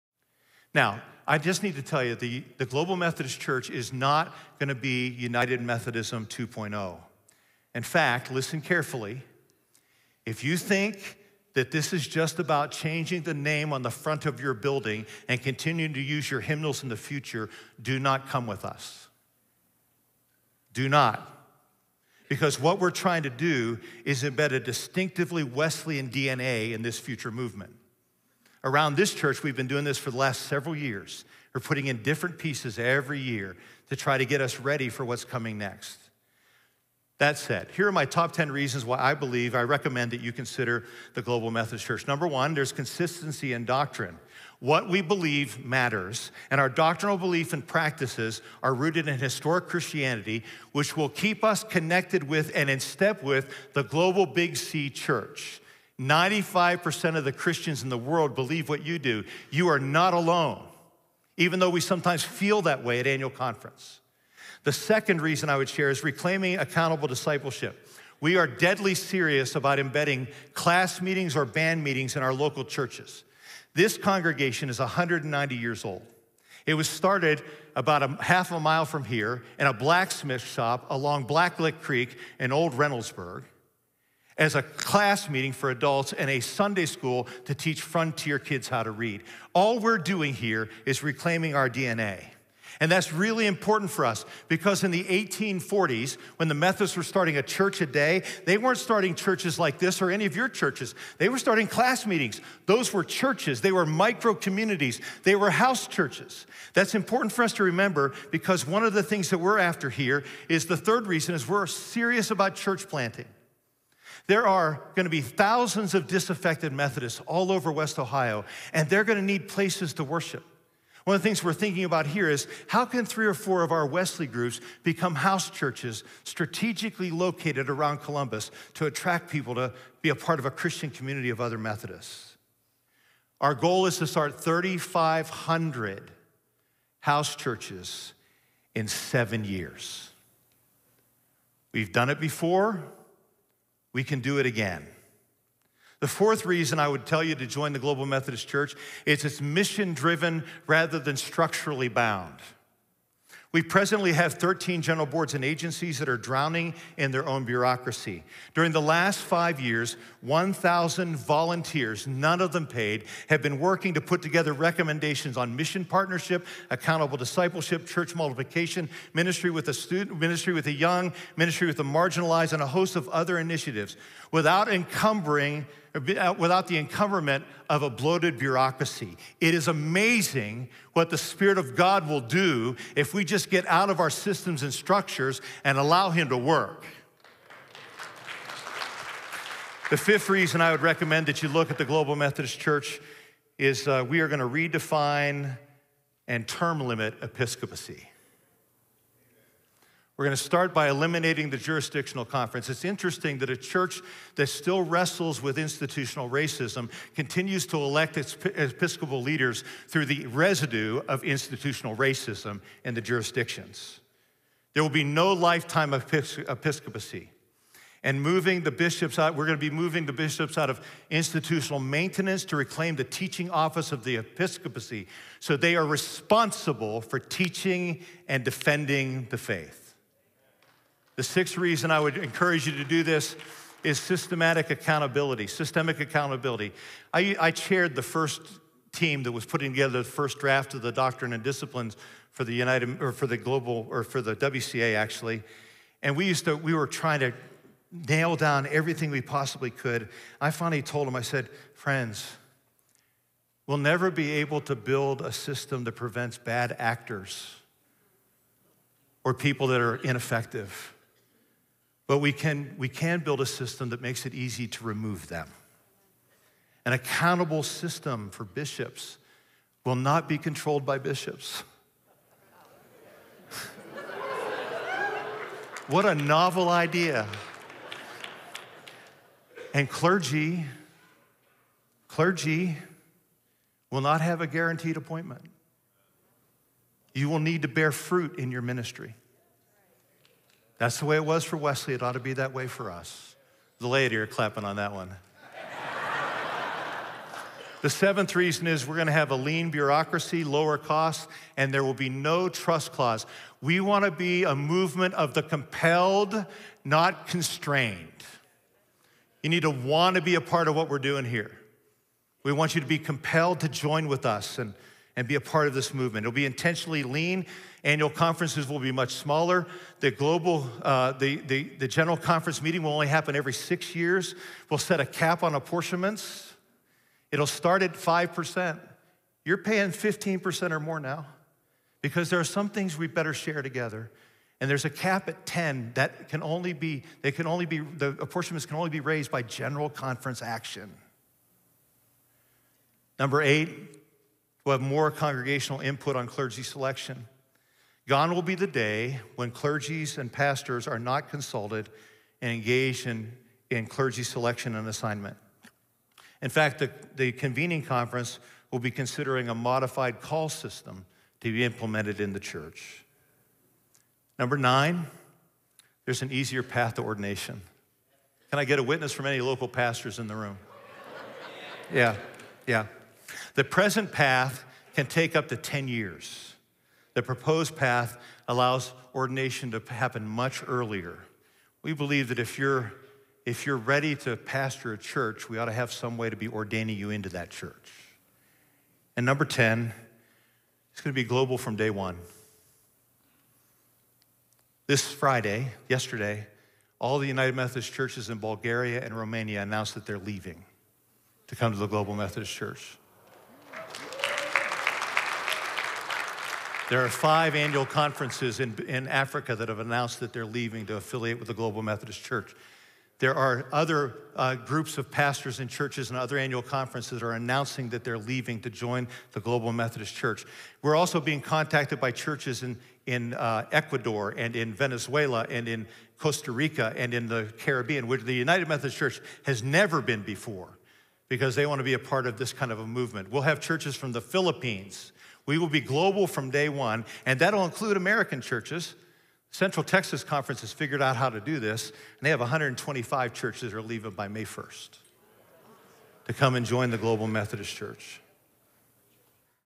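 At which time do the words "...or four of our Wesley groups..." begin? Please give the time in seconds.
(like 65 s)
123 s.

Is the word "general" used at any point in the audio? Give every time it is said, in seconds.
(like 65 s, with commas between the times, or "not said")
154 s, 321 s, 339 s.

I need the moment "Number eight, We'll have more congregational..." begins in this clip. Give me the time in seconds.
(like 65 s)
343 s.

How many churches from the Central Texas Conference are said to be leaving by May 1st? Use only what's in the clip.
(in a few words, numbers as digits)
125.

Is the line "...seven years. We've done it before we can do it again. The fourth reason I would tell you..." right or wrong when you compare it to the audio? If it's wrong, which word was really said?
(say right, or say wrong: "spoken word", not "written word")
right.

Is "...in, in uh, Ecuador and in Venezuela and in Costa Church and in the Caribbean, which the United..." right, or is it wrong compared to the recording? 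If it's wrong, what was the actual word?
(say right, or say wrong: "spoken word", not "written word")
wrong: "Rica", not "Church".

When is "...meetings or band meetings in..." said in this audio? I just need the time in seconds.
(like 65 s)
71 s.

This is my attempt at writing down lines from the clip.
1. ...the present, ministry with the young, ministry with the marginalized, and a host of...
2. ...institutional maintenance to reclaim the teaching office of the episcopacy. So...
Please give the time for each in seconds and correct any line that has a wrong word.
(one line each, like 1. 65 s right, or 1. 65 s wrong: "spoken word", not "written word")
1. 169 s wrong: "student", not "present"
2. 221 s right.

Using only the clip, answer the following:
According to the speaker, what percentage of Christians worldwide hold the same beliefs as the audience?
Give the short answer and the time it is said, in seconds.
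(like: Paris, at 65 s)
95%, at 56 s.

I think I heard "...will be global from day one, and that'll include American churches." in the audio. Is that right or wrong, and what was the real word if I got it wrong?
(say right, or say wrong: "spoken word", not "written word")
right.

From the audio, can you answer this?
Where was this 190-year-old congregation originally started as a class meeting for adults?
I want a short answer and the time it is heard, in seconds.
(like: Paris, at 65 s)
In a blacksmith shop, at 79 s.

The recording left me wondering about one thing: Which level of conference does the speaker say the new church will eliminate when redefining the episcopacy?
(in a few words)
The jurisdictional conference.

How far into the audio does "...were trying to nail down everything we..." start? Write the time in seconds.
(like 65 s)
246 s.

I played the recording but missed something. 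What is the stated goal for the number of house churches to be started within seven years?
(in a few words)
3,500.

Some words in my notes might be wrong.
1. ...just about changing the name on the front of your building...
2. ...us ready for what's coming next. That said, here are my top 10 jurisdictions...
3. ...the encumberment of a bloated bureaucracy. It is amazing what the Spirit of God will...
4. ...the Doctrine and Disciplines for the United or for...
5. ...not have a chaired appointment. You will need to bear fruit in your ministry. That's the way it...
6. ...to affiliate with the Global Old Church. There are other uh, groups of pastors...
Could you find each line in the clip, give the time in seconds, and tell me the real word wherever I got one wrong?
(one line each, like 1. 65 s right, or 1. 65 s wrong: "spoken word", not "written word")
1. 12 s right
2. 34 s wrong: "reasons", not "jurisdictions"
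3. 176 s right
4. 240 s right
5. 284 s wrong: "guaranteed", not "chaired"
6. 410 s wrong: "Methodist", not "Old".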